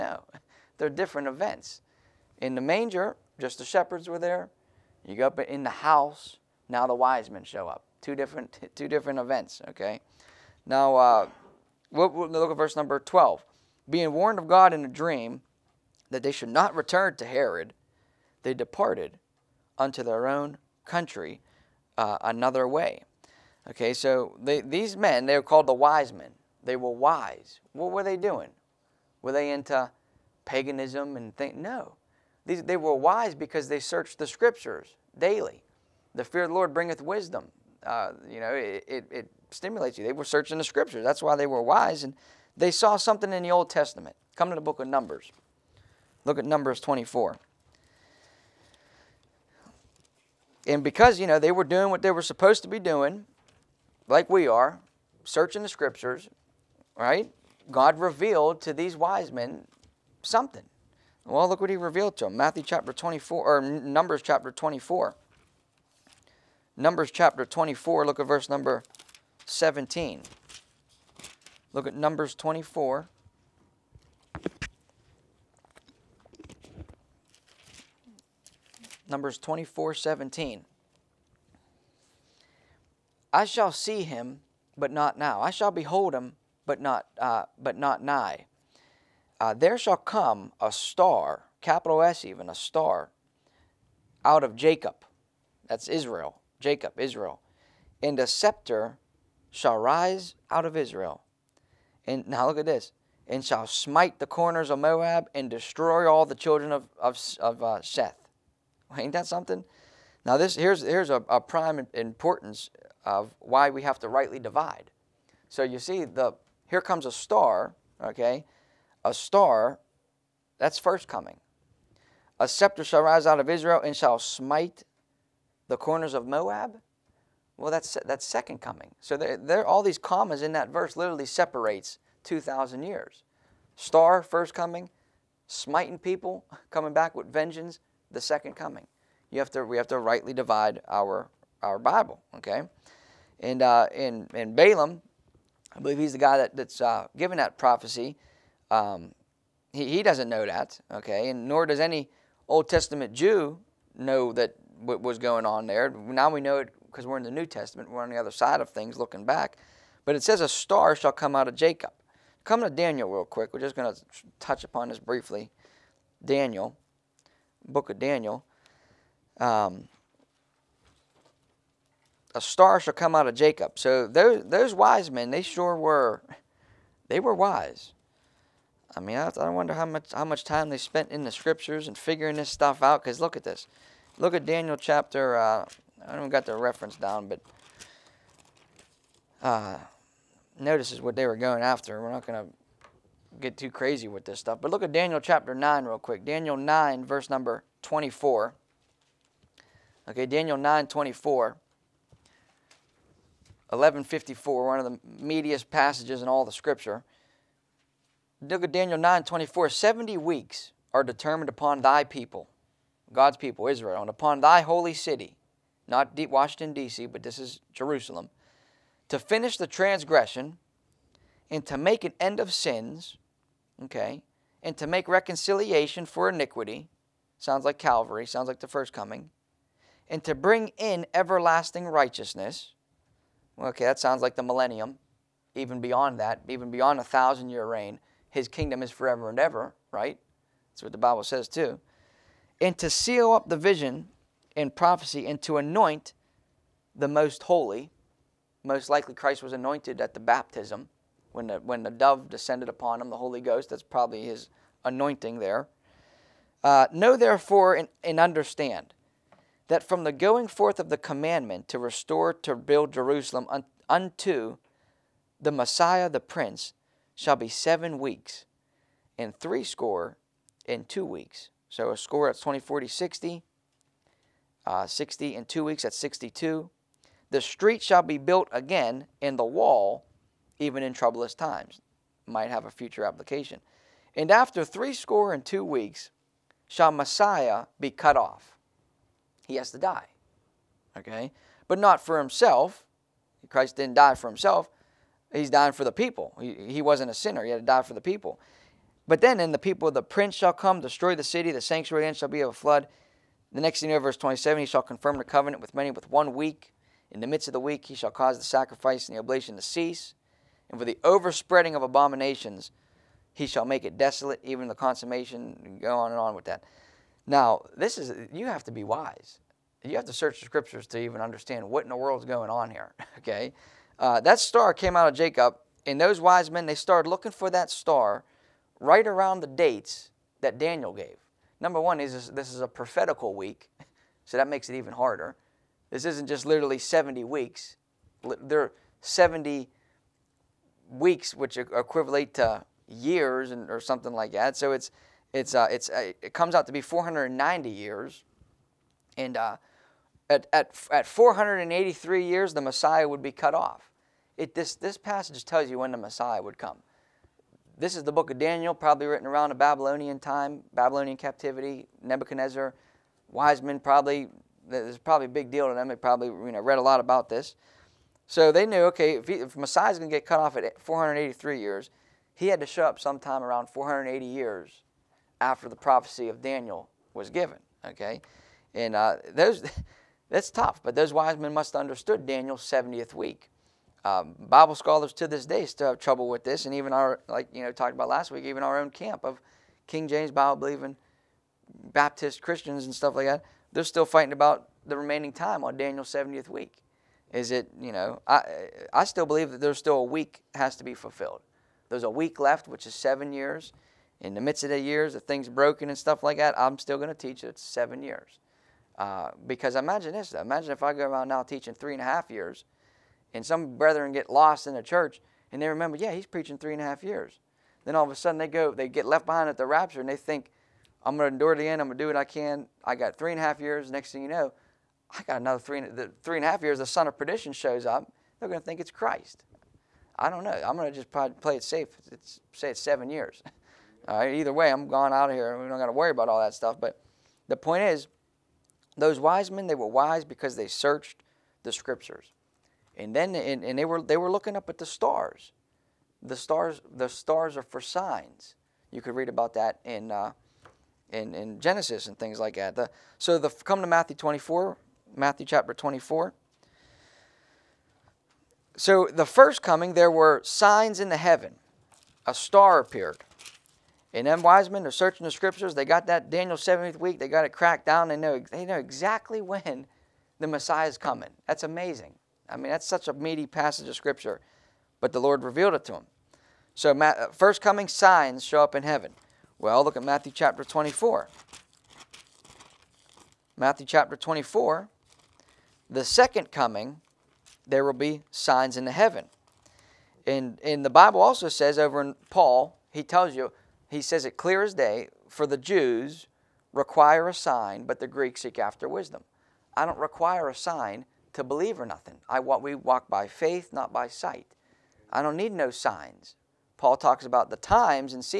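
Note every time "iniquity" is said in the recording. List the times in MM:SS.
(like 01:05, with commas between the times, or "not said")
03:46.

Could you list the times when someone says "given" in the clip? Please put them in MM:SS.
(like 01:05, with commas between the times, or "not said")
02:27, 06:17.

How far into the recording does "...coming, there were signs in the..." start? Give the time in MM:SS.
07:39.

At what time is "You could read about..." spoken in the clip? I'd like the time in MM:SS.
07:28.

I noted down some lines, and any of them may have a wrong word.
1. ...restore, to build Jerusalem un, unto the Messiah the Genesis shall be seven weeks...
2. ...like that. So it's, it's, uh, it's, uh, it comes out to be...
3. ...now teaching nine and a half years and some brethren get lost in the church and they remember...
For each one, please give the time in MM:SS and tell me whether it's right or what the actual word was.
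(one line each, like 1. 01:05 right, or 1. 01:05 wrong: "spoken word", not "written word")
1. 04:21 wrong: "Prince", not "Genesis"
2. 05:44 right
3. 06:51 wrong: "three", not "nine".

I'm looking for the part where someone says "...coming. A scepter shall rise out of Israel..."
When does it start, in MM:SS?
02:01.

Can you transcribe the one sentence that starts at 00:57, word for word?
God revealed to these wise men something.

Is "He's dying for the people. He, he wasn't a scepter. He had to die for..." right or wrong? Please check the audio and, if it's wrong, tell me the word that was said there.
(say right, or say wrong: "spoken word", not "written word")
wrong: "sinner", not "scepter".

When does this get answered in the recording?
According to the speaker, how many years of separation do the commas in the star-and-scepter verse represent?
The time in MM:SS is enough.
02:12.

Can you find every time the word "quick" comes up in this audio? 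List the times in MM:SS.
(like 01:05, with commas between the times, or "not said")
02:43, 03:15.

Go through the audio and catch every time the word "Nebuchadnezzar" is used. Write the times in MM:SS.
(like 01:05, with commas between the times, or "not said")
06:02.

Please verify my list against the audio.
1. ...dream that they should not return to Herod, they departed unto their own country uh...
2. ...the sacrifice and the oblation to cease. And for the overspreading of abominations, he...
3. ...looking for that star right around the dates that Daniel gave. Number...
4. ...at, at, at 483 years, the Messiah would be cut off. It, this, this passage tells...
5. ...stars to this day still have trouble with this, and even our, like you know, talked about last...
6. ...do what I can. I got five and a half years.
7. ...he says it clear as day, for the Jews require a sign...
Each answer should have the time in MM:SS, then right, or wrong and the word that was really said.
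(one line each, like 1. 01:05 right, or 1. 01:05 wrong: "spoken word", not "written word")
1. 00:14 right
2. 05:08 right
3. 05:27 right
4. 05:50 right
5. 06:24 wrong: "scholars", not "stars"
6. 07:02 wrong: "three", not "five"
7. 08:13 right.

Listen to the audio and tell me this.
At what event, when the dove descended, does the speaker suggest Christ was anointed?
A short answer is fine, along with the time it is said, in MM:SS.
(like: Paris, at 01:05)
the baptism, at 04:10.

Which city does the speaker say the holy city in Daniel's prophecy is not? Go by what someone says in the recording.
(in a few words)
Washington, D.C.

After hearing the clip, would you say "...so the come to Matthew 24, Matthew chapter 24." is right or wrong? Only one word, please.
right.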